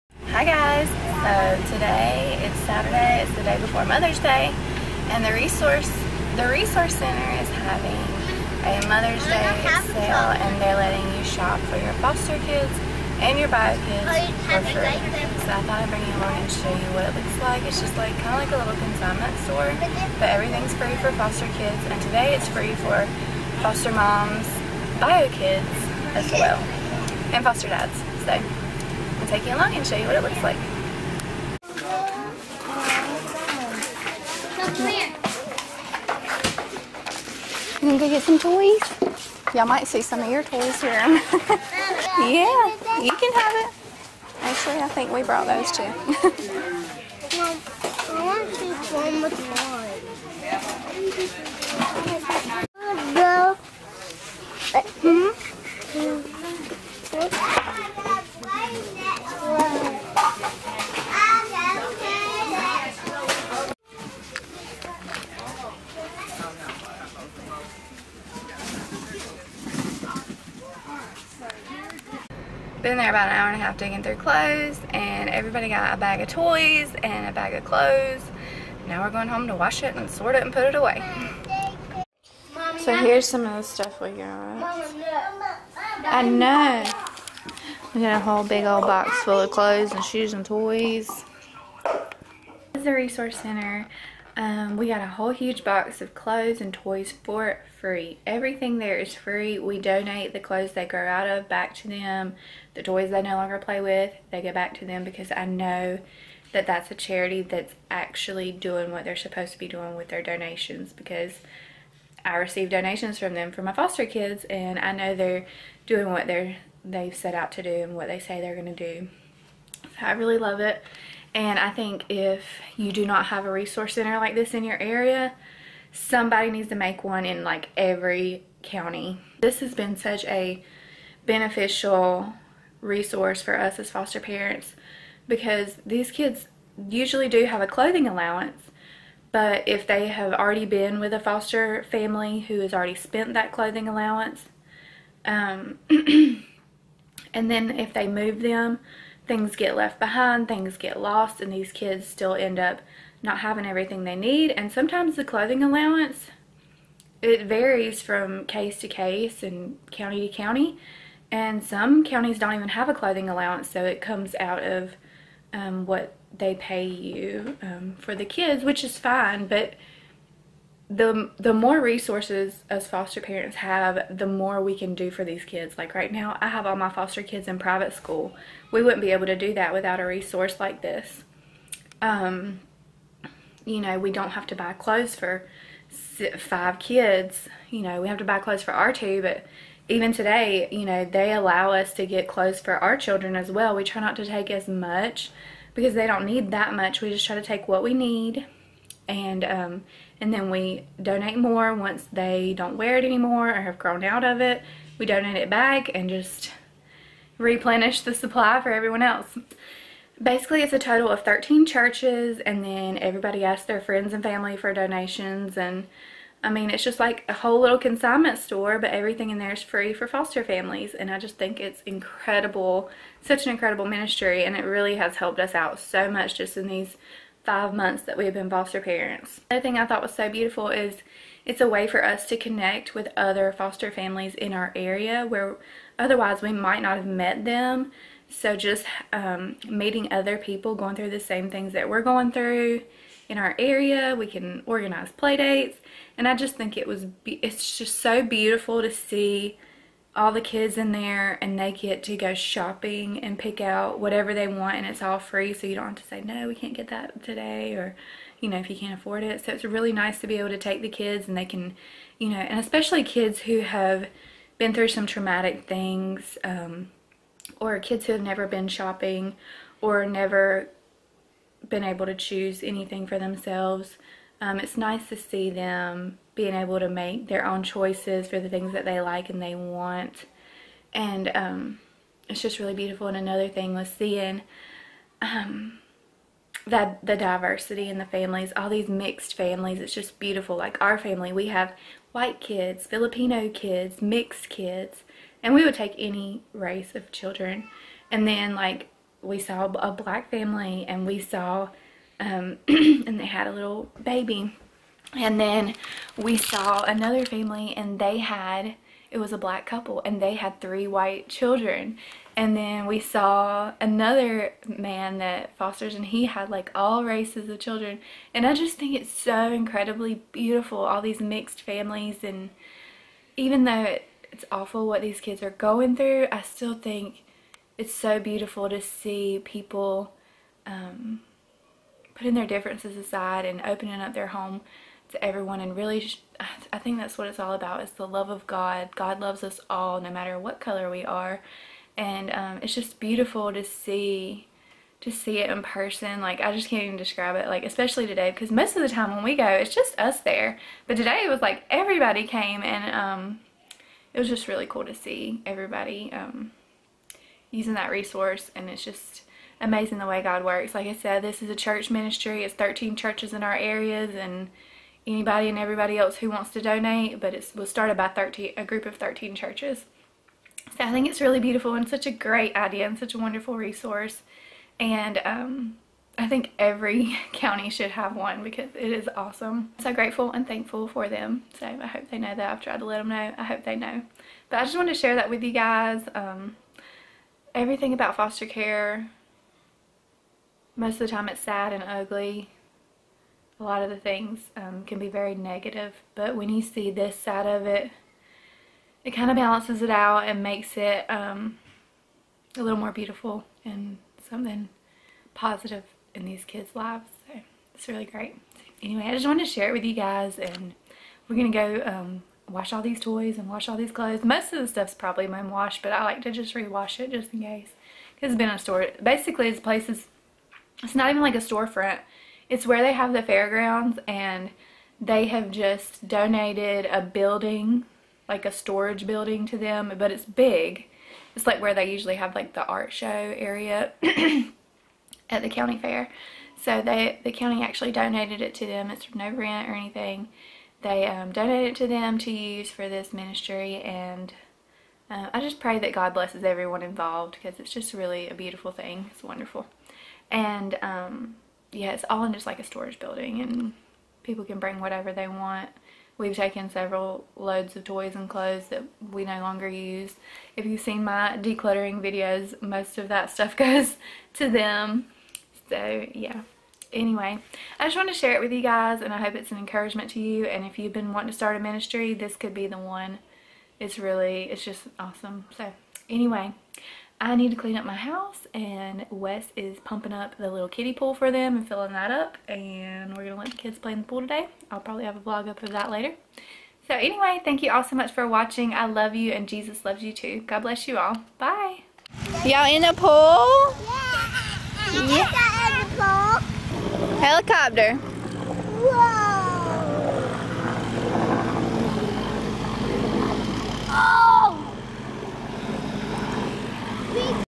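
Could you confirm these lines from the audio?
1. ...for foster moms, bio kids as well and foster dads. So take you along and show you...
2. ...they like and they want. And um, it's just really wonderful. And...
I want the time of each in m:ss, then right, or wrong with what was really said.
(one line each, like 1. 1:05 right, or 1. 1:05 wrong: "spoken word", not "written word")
1. 0:22 right
2. 4:38 wrong: "beautiful", not "wonderful".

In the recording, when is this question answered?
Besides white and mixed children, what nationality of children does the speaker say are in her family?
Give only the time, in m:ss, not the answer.
4:52.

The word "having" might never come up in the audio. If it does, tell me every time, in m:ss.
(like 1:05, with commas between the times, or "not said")
0:07, 2:33.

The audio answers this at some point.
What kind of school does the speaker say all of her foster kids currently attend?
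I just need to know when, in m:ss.
2:57.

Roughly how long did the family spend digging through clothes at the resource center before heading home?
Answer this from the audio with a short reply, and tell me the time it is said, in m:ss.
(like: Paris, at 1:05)
an hour and a half, at 1:13.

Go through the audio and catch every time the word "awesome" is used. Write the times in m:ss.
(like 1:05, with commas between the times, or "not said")
6:19, 7:54.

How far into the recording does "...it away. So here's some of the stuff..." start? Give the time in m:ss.
1:20.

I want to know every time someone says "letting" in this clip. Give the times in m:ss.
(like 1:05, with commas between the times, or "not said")
0:10.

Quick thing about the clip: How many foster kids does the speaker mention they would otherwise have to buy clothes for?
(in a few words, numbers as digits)
5.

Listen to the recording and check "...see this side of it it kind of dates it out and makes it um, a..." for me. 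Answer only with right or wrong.
wrong.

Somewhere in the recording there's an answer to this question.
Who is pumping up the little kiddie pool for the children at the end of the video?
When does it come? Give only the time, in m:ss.
7:59.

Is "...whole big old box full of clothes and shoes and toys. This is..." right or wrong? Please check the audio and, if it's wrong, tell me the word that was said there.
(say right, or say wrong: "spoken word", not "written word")
right.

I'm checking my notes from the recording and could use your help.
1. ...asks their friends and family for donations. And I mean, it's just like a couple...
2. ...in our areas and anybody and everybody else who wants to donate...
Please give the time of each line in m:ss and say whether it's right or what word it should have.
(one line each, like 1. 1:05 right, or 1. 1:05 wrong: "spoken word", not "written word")
1. 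3:33 wrong: "whole", not "couple"
2. 6:03 right.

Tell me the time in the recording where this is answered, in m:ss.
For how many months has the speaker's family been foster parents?
3:47.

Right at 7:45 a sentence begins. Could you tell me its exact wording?
So yeah, anyway, I just want to share it with you guys and I hope it's an encouragement to you.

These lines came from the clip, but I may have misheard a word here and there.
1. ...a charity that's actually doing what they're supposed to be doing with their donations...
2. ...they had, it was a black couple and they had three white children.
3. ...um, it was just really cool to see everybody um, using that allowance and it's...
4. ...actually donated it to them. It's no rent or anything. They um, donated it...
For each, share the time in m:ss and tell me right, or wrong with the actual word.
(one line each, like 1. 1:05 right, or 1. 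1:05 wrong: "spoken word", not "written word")
1. 1:46 right
2. 5:07 right
3. 5:52 wrong: "resource", not "allowance"
4. 7:17 right.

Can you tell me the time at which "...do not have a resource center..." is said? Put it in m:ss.
2:02.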